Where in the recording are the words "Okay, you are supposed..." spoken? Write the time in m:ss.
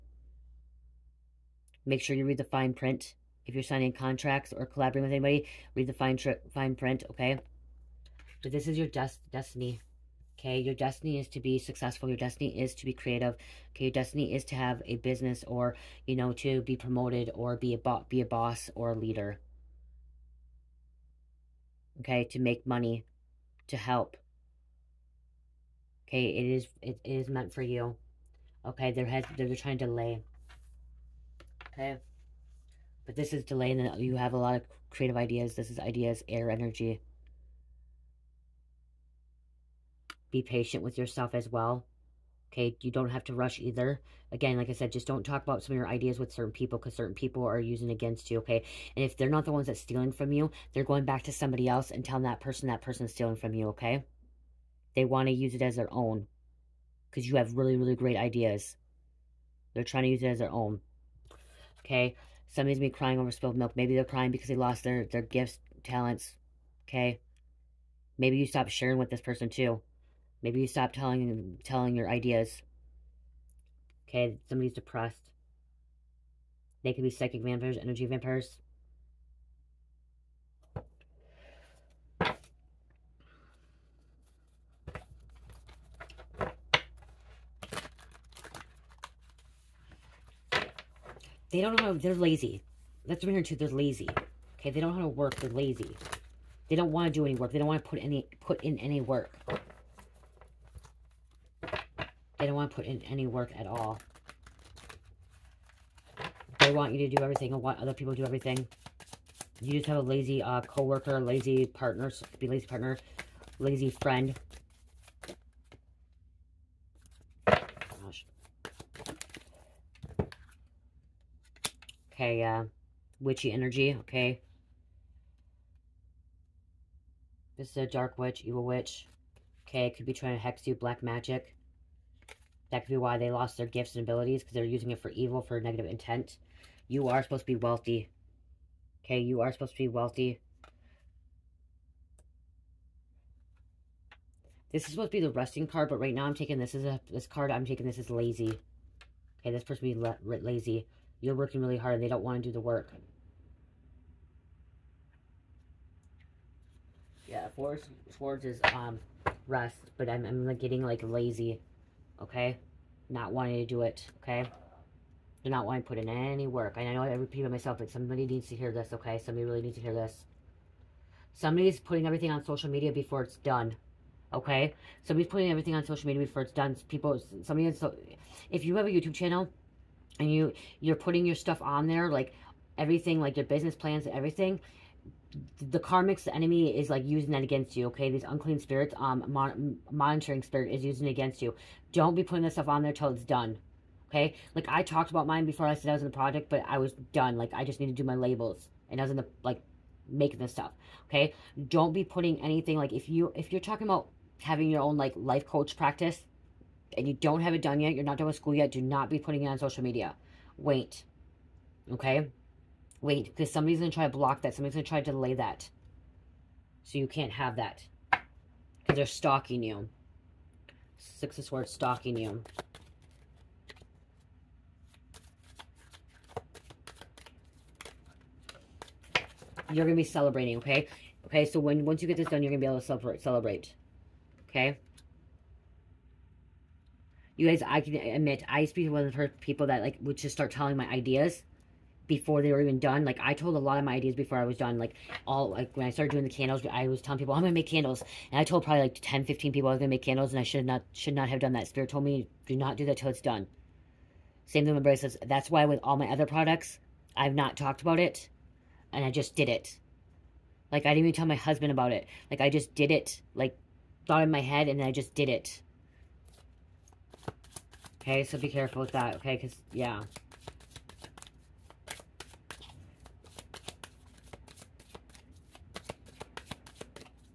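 2:19.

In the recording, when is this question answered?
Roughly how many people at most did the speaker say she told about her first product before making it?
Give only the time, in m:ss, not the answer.
4:09.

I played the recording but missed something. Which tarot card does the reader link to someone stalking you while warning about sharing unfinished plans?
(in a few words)
Six of Swords.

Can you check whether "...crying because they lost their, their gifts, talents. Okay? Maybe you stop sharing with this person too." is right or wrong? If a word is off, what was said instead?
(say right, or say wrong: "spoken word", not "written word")
right.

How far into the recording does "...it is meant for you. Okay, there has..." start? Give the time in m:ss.
0:26.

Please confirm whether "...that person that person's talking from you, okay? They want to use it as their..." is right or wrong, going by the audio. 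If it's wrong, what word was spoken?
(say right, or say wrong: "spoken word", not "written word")
wrong: "stealing", not "talking".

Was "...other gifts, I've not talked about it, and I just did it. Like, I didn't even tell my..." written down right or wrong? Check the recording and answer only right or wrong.
wrong.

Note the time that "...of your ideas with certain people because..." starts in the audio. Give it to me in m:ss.
0:45.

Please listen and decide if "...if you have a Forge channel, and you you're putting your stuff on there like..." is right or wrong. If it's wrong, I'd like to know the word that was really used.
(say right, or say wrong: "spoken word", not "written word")
wrong: "YouTube", not "Forge".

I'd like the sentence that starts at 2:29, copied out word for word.
Okay, this person be la lazy.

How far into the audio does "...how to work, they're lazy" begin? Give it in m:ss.
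1:35.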